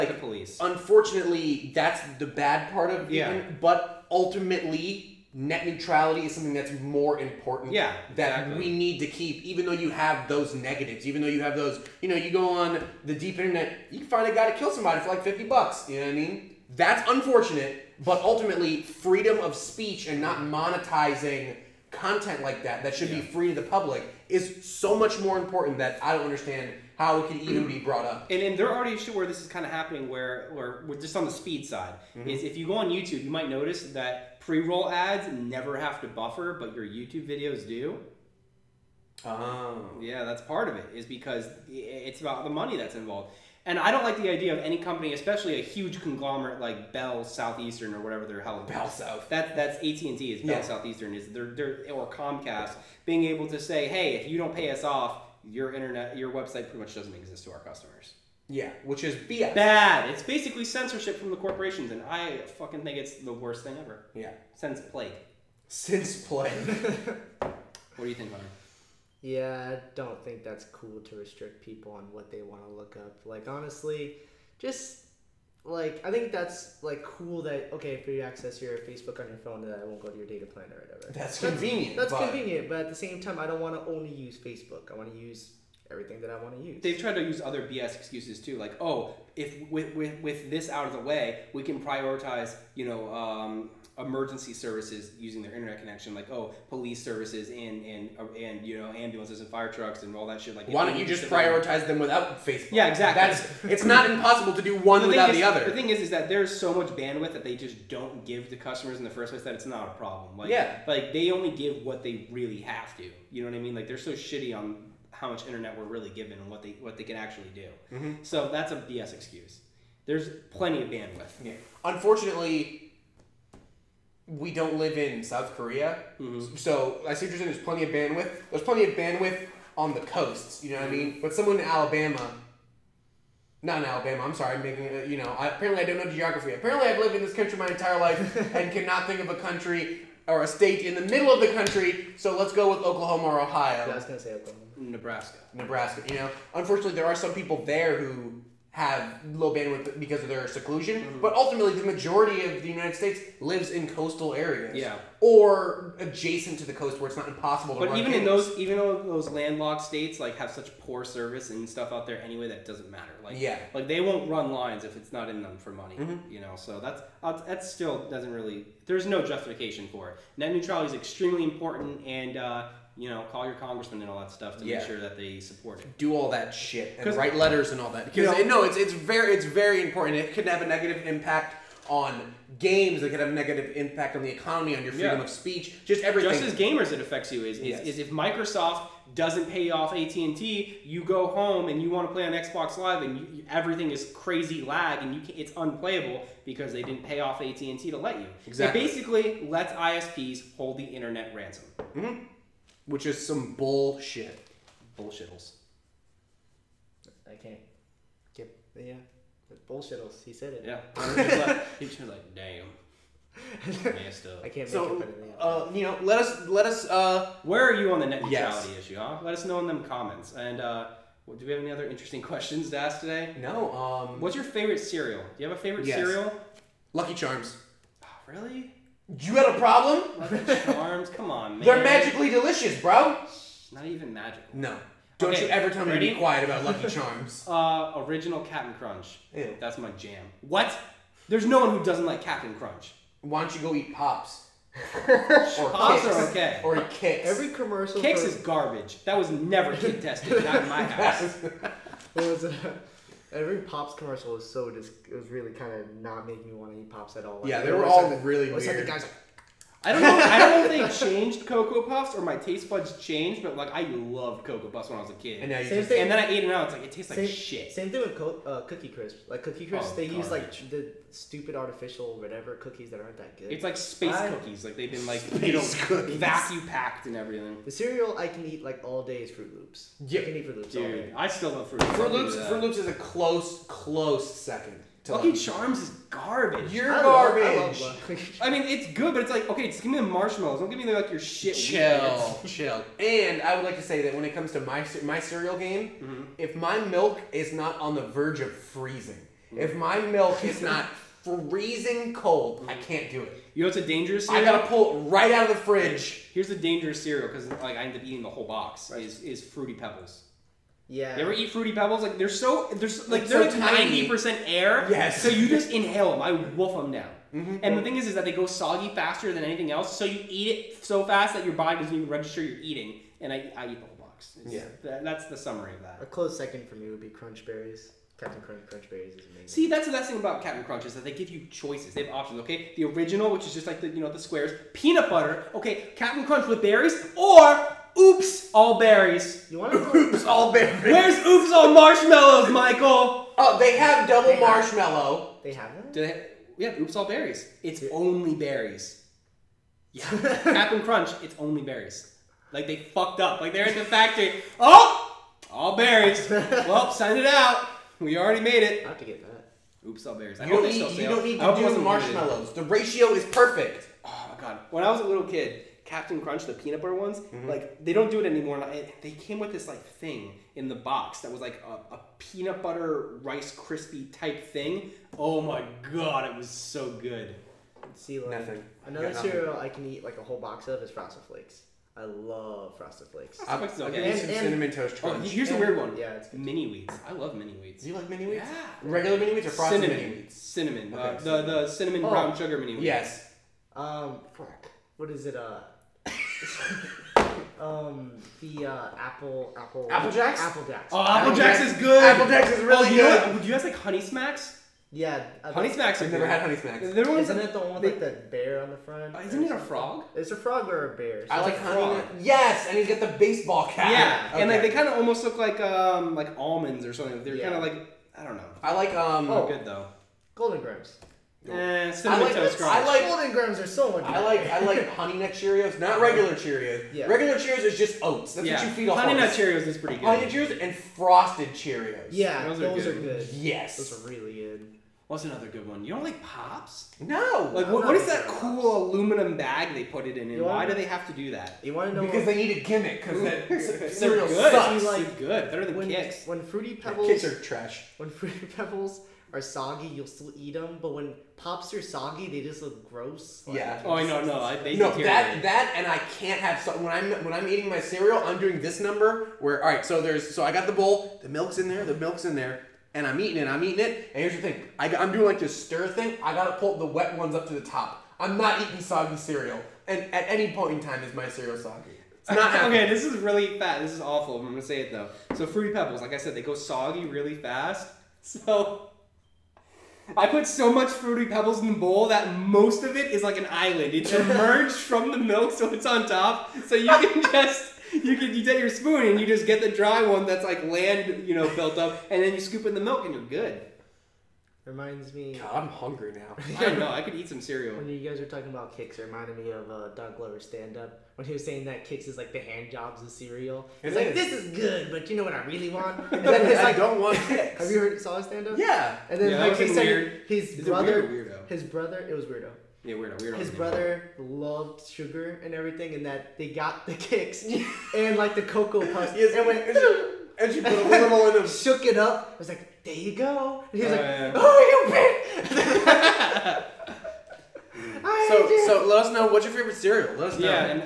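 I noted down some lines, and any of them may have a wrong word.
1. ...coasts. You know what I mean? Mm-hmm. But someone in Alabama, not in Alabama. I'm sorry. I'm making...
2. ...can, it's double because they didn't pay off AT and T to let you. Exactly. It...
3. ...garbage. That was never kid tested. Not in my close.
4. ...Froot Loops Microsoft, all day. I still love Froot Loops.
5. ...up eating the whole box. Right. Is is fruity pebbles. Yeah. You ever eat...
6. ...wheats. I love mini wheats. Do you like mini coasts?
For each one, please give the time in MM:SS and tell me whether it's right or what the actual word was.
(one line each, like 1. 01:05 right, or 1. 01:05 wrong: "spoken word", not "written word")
1. 02:10 right
2. 03:15 wrong: "unplayable", not "double"
3. 04:08 wrong: "house", not "close"
4. 04:40 wrong: "Dude", not "Microsoft"
5. 05:07 right
6. 06:26 wrong: "wheats", not "coasts".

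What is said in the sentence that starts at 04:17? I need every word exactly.
Like, yeah, they, were all like, really.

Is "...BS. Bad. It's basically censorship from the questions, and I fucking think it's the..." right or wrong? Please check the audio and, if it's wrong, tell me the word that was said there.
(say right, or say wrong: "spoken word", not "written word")
wrong: "corporations", not "questions".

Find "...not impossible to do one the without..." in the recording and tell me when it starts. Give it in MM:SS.
01:43.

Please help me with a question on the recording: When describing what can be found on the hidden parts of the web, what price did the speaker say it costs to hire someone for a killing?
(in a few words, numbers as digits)
50 bucks.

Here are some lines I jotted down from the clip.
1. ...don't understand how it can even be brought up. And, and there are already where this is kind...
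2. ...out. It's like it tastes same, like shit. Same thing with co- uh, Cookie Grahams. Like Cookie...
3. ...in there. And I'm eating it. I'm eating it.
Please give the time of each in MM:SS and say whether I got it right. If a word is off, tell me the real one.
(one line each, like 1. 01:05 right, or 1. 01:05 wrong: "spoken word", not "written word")
1. 00:26 right
2. 04:26 wrong: "Crisp", not "Grahams"
3. 07:42 right.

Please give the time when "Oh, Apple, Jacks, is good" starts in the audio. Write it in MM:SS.
06:40.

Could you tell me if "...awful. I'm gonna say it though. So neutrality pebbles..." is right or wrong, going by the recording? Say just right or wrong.
wrong.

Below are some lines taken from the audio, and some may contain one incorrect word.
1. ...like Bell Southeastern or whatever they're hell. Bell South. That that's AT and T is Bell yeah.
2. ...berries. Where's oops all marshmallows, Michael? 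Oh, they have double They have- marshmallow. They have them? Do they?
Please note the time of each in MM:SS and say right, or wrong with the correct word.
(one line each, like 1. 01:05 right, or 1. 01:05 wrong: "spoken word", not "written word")
1. 00:46 right
2. 05:40 right.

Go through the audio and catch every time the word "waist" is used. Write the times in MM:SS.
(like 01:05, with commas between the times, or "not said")
not said.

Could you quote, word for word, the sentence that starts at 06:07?
like they don't do it anymore.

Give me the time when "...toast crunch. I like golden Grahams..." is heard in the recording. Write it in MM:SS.
07:02.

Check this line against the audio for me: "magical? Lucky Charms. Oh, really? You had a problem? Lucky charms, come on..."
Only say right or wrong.
wrong.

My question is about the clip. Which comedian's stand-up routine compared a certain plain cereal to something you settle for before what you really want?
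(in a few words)
Doug Glover.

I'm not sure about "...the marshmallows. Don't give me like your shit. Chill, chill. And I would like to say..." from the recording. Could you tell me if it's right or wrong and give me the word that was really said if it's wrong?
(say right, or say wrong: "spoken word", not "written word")
right.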